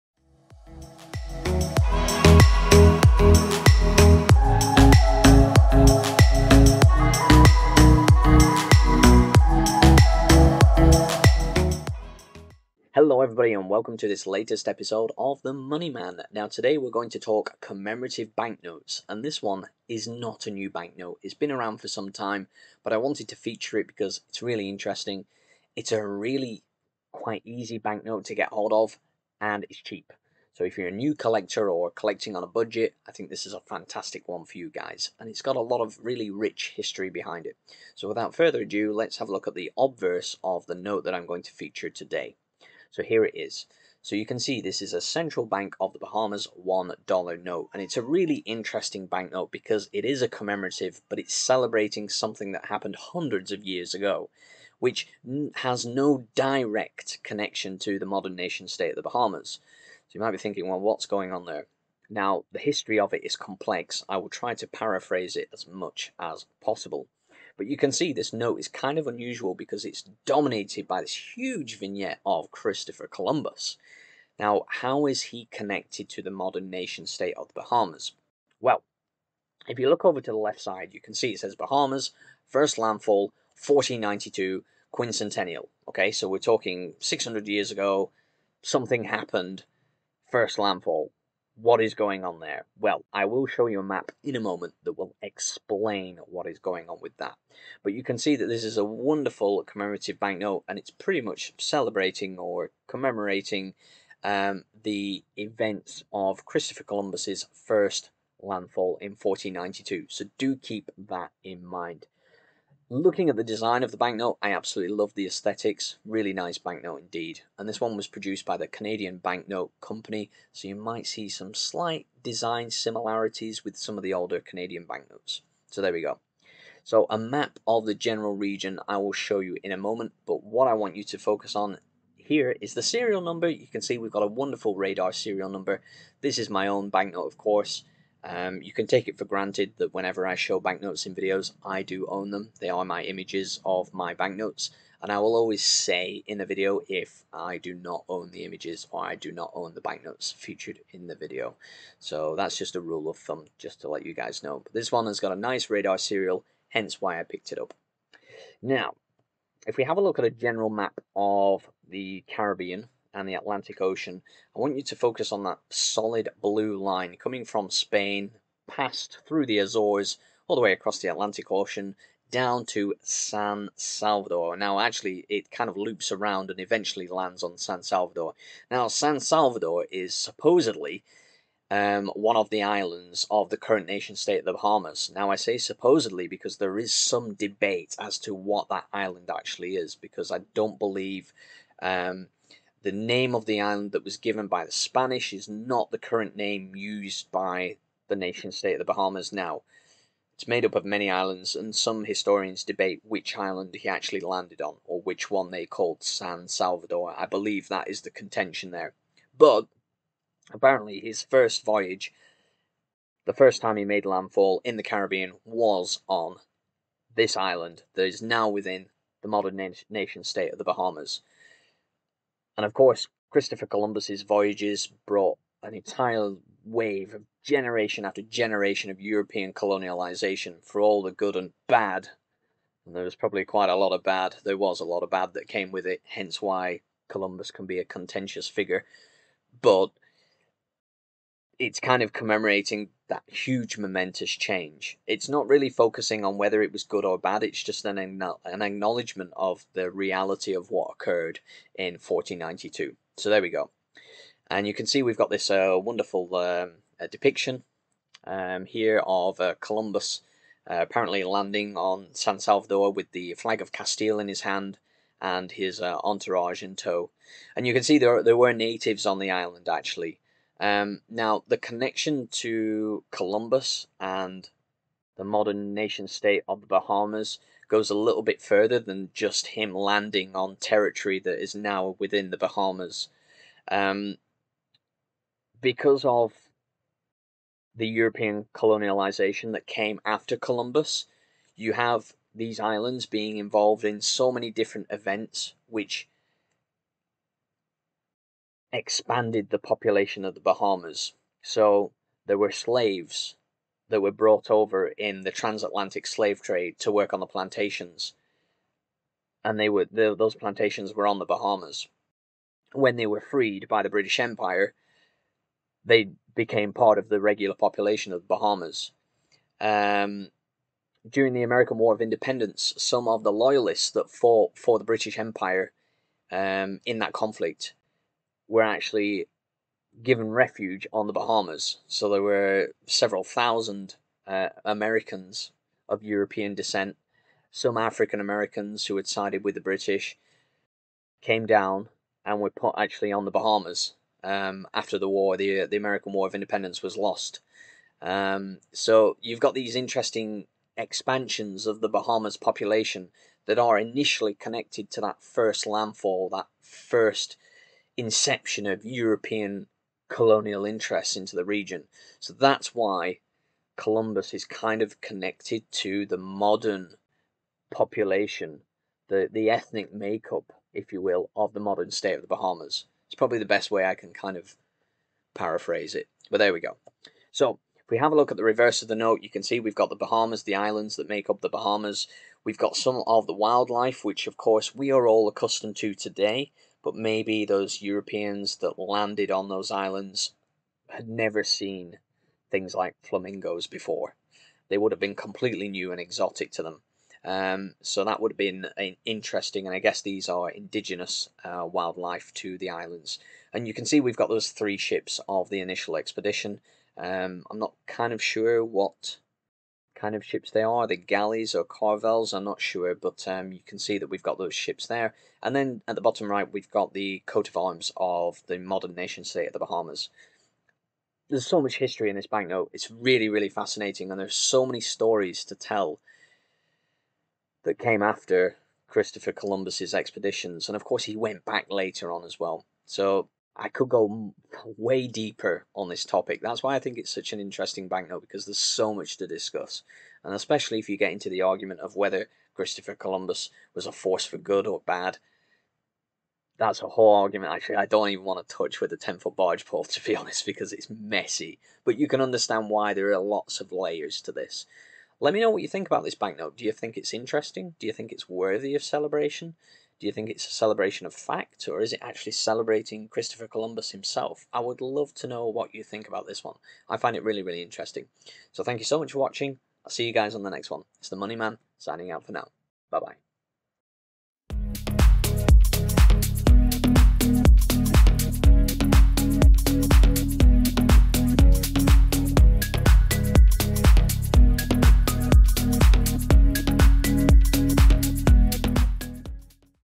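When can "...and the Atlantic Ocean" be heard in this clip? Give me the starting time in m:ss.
2:43.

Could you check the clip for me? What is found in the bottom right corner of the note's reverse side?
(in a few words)
Coat of arms.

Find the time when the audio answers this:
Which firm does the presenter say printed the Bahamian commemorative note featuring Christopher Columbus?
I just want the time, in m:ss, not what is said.
1:58.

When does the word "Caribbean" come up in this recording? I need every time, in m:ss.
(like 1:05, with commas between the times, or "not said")
2:42, 3:34.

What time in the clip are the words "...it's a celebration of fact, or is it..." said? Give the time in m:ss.
7:40.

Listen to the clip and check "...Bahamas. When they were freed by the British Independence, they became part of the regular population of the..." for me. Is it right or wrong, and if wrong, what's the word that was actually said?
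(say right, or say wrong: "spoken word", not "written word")
wrong: "Empire", not "Independence".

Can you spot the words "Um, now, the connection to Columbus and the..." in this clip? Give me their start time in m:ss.
4:30.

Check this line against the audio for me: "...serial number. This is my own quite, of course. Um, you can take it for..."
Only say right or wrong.
wrong.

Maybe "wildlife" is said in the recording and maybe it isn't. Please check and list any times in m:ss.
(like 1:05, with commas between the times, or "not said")
6:23, 6:41.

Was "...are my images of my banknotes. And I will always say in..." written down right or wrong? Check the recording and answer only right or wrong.
right.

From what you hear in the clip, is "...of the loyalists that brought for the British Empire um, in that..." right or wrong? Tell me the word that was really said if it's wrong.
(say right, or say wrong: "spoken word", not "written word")
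wrong: "fought", not "brought".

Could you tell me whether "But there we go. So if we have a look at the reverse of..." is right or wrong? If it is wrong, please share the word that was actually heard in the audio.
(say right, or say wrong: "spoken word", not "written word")
right.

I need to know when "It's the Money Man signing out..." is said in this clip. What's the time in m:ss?
7:50.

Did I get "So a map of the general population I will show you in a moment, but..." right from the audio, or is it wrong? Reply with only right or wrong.
wrong.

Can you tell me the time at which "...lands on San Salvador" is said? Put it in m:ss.
2:57.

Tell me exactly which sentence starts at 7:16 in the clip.
That's why I think it's such an interesting banknote because there's so much to discuss.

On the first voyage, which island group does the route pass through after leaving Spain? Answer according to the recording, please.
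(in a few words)
The Azores.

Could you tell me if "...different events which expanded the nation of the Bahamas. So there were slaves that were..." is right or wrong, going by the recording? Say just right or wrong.
wrong.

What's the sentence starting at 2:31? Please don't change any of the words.
So that's just a rule of thumb, just to let you guys know.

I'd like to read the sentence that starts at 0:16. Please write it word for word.
Now, today we're going to talk commemorative banknotes, and this one is not a new banknote.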